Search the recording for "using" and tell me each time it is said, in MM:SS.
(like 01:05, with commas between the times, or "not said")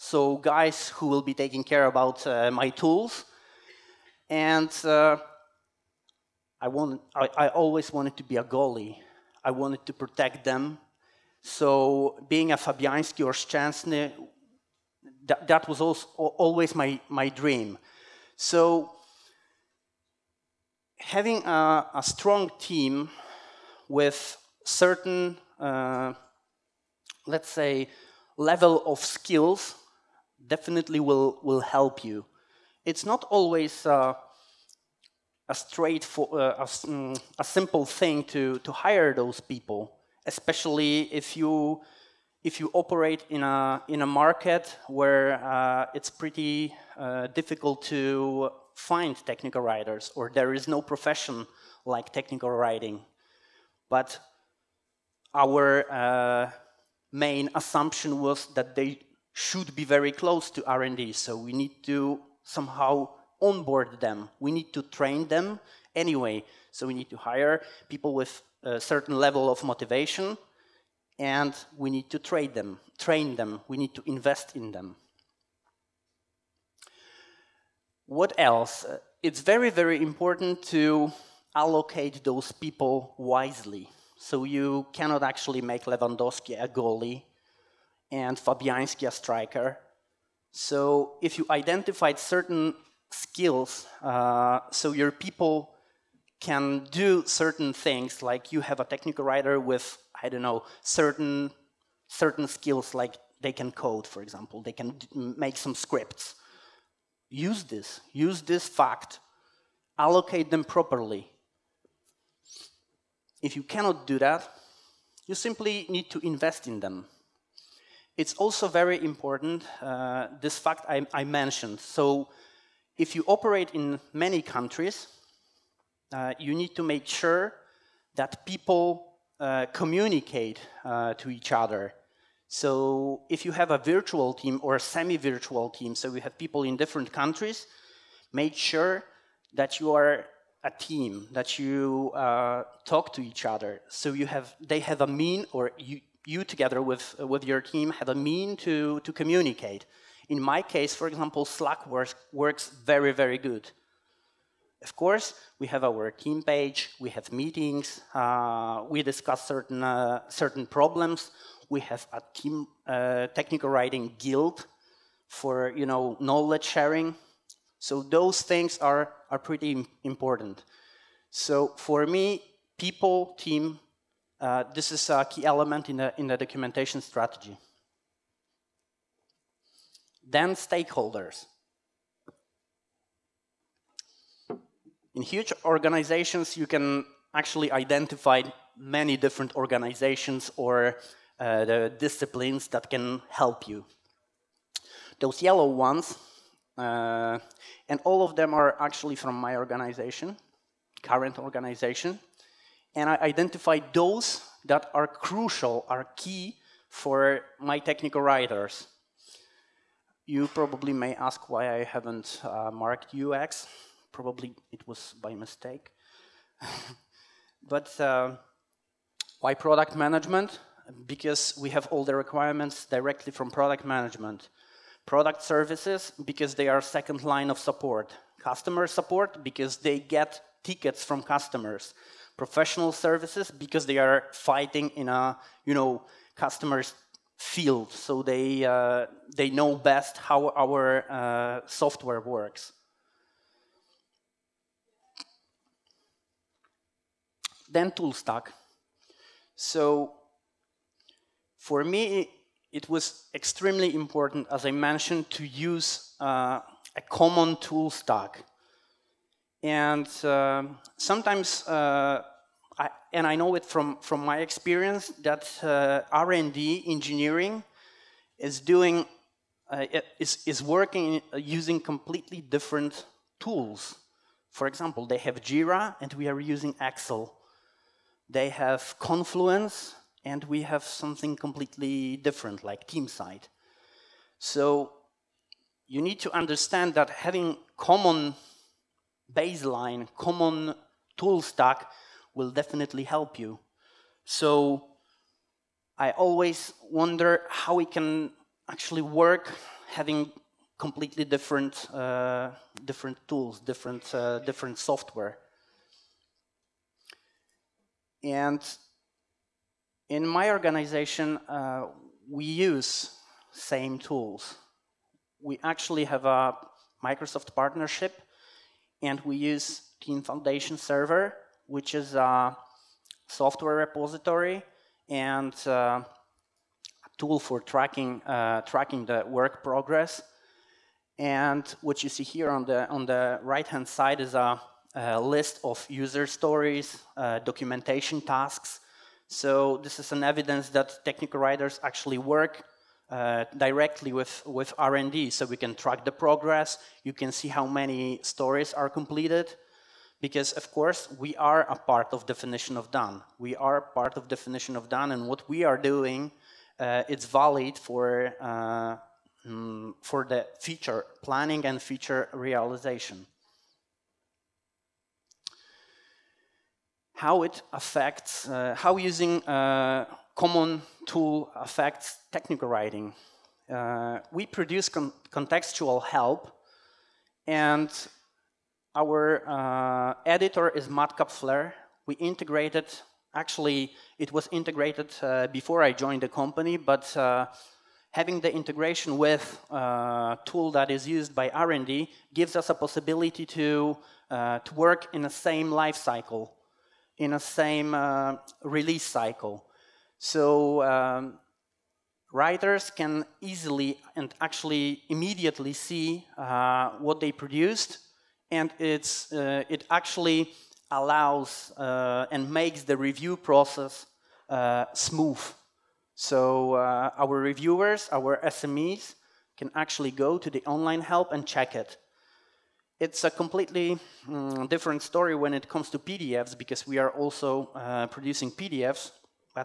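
04:31, 04:36, 06:08.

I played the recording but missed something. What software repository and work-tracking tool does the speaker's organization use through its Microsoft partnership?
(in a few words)
Team Foundation Server.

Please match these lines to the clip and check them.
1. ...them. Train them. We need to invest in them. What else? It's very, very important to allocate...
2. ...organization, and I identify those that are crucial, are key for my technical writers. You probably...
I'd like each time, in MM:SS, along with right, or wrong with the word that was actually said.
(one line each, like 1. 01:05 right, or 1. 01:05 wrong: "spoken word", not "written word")
1. 01:12 right
2. 03:21 right.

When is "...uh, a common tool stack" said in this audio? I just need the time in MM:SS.
04:16.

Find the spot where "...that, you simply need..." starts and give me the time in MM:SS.
01:54.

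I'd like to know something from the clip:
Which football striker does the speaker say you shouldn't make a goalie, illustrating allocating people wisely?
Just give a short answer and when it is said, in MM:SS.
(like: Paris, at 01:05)
Lewandowski, at 01:25.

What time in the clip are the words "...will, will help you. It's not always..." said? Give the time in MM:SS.
00:30.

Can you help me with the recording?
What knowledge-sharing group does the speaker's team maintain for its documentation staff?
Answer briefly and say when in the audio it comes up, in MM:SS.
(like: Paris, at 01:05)
technical writing guild, at 02:43.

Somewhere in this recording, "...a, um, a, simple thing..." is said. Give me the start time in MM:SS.
00:36.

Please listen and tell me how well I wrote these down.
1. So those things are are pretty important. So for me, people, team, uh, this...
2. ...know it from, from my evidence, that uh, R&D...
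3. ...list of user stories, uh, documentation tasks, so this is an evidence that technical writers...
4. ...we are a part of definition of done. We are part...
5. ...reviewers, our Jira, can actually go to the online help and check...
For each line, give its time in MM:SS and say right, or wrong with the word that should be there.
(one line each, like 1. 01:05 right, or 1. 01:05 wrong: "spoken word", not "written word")
1. 02:47 right
2. 04:23 wrong: "experience", not "evidence"
3. 05:35 right
4. 05:51 right
5. 06:57 wrong: "SMEs", not "Jira".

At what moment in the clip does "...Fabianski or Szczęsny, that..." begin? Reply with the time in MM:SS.
00:12.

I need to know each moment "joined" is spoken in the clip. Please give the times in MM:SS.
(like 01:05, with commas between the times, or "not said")
06:25.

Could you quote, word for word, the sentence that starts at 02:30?
In my case, for example, Slack works, works very, very good.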